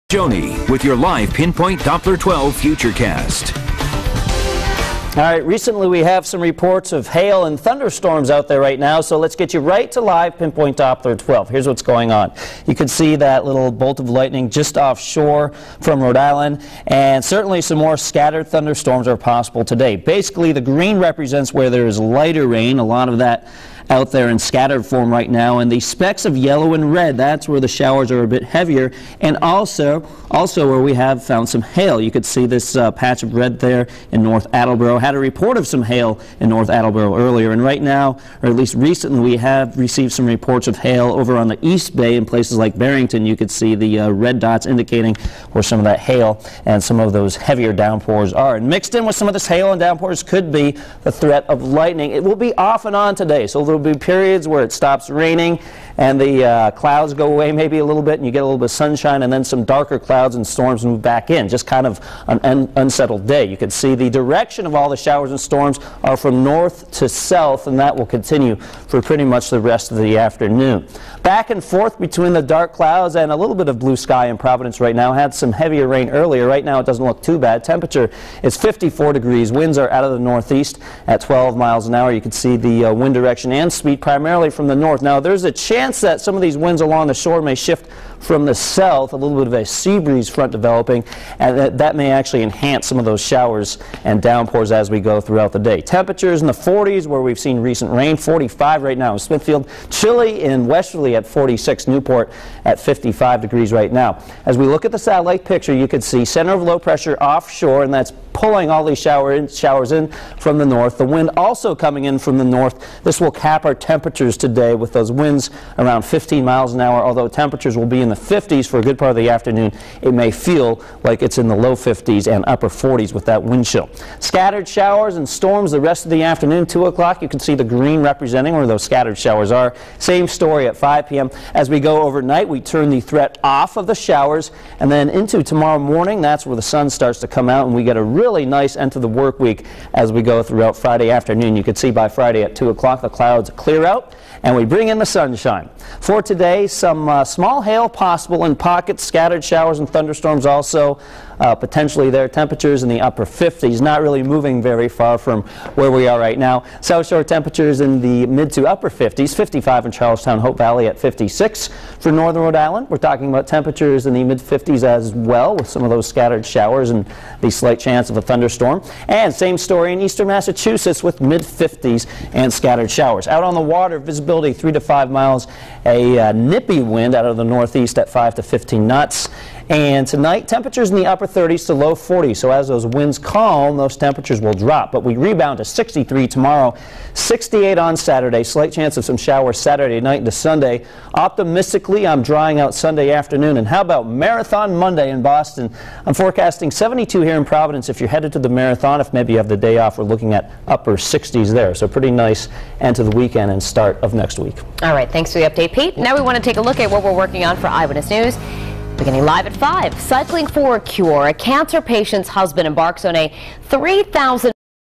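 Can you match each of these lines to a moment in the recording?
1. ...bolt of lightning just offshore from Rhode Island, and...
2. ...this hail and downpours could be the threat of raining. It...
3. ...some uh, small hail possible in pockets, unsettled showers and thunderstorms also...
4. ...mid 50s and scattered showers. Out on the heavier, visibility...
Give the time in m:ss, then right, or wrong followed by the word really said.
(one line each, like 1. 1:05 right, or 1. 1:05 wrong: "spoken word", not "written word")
1. 0:13 right
2. 0:49 wrong: "lightning", not "raining"
3. 2:26 wrong: "scattered", not "unsettled"
4. 2:51 wrong: "water", not "heavier".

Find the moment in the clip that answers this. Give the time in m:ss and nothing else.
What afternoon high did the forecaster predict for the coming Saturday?
3:07.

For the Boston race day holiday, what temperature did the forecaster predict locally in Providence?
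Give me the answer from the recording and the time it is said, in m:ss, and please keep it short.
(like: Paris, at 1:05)
72, at 3:16.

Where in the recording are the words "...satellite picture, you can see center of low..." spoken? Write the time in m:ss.
1:44.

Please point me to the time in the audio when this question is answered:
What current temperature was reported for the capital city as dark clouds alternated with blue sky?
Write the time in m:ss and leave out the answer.
1:18.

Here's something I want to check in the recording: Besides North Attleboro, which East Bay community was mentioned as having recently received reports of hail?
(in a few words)
Barrington.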